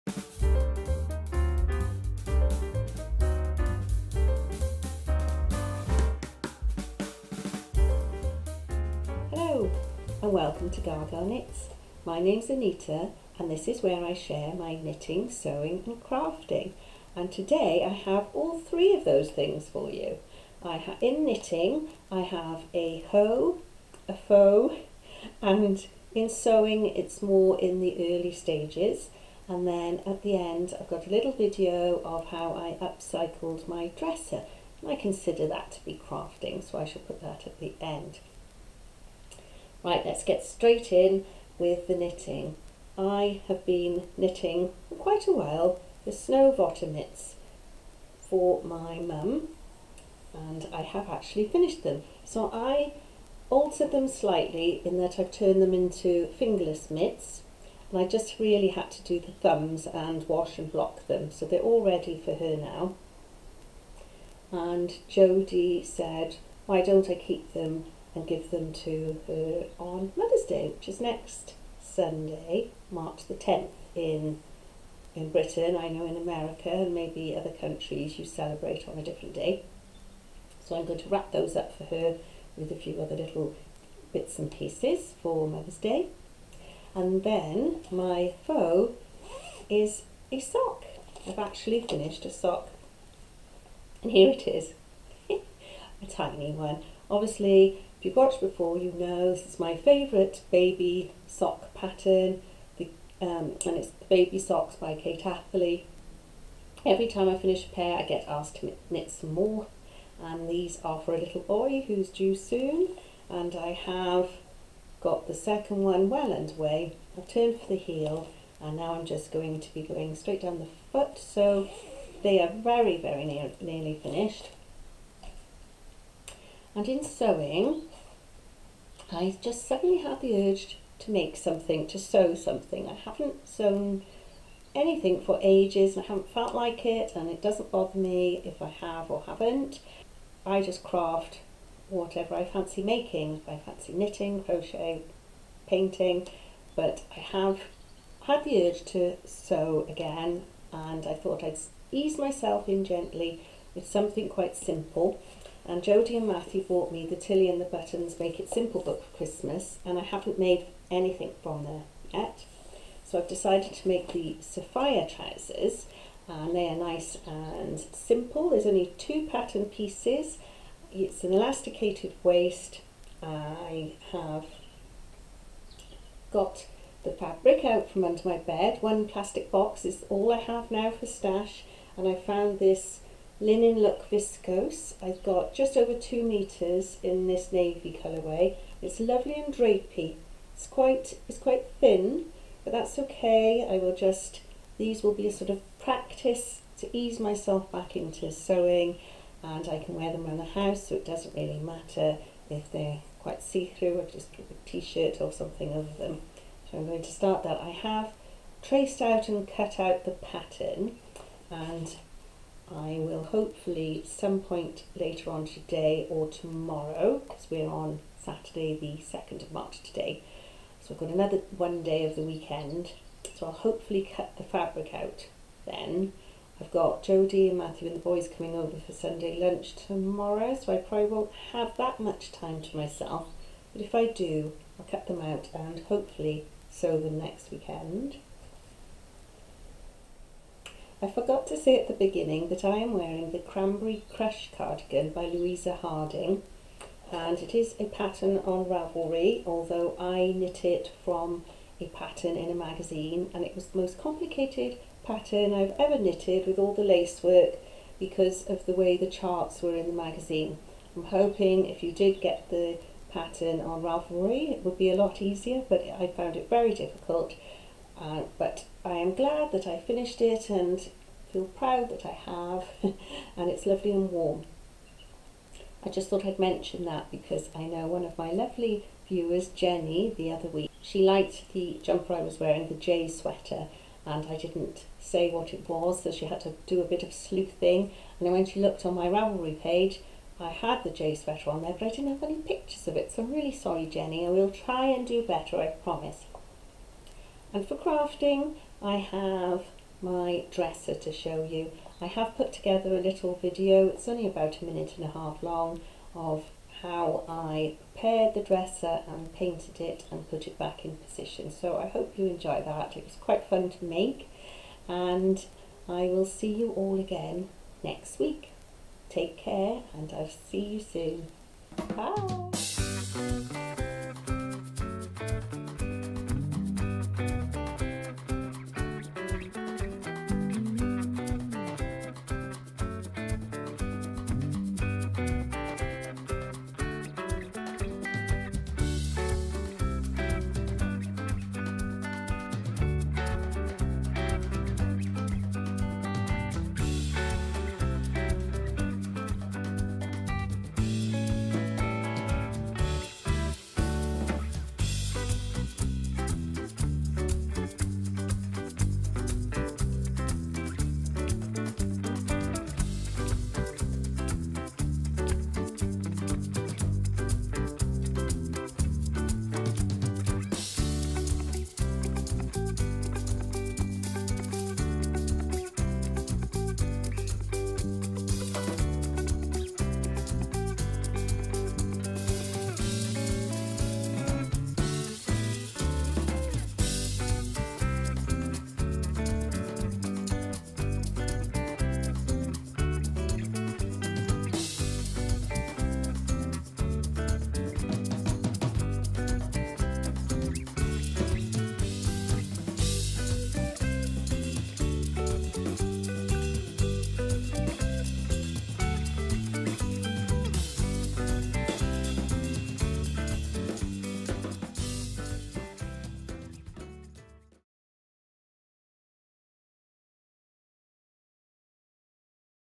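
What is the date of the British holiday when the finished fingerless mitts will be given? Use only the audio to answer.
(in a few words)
March 10th.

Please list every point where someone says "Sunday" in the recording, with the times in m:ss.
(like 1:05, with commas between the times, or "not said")
1:11, 3:48.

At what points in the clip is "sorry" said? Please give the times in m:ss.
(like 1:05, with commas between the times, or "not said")
4:53.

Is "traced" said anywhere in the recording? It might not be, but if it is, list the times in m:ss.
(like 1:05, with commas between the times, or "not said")
3:28.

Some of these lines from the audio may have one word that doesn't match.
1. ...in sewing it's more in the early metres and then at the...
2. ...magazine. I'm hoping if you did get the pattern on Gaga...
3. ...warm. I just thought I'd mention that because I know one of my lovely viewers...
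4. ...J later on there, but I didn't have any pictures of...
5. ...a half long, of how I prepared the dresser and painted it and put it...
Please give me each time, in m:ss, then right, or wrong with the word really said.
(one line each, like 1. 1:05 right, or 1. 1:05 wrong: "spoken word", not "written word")
1. 0:26 wrong: "stages", not "metres"
2. 4:20 wrong: "Ravelry", not "Gaga"
3. 4:34 right
4. 4:50 wrong: "sweater", not "later"
5. 5:05 right.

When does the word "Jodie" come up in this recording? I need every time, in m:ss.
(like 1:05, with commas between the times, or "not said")
2:35, 3:47.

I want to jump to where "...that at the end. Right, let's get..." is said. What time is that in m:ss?
0:37.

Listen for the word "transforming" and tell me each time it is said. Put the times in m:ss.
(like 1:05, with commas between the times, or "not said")
not said.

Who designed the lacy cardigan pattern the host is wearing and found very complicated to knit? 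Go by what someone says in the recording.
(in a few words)
Louisa Harding.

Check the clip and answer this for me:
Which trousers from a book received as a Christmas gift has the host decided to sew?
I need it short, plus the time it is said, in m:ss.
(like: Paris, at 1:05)
Safiya trousers, at 2:44.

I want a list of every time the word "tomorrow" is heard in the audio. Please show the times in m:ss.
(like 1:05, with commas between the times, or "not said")
3:36, 3:49.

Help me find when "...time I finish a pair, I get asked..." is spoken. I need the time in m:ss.
1:47.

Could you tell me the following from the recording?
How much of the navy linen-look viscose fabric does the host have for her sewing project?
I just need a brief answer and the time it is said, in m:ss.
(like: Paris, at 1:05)
just over 2 metres, at 3:05.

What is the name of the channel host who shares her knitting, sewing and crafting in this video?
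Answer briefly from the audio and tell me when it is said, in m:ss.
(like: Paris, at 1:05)
Anita, at 0:12.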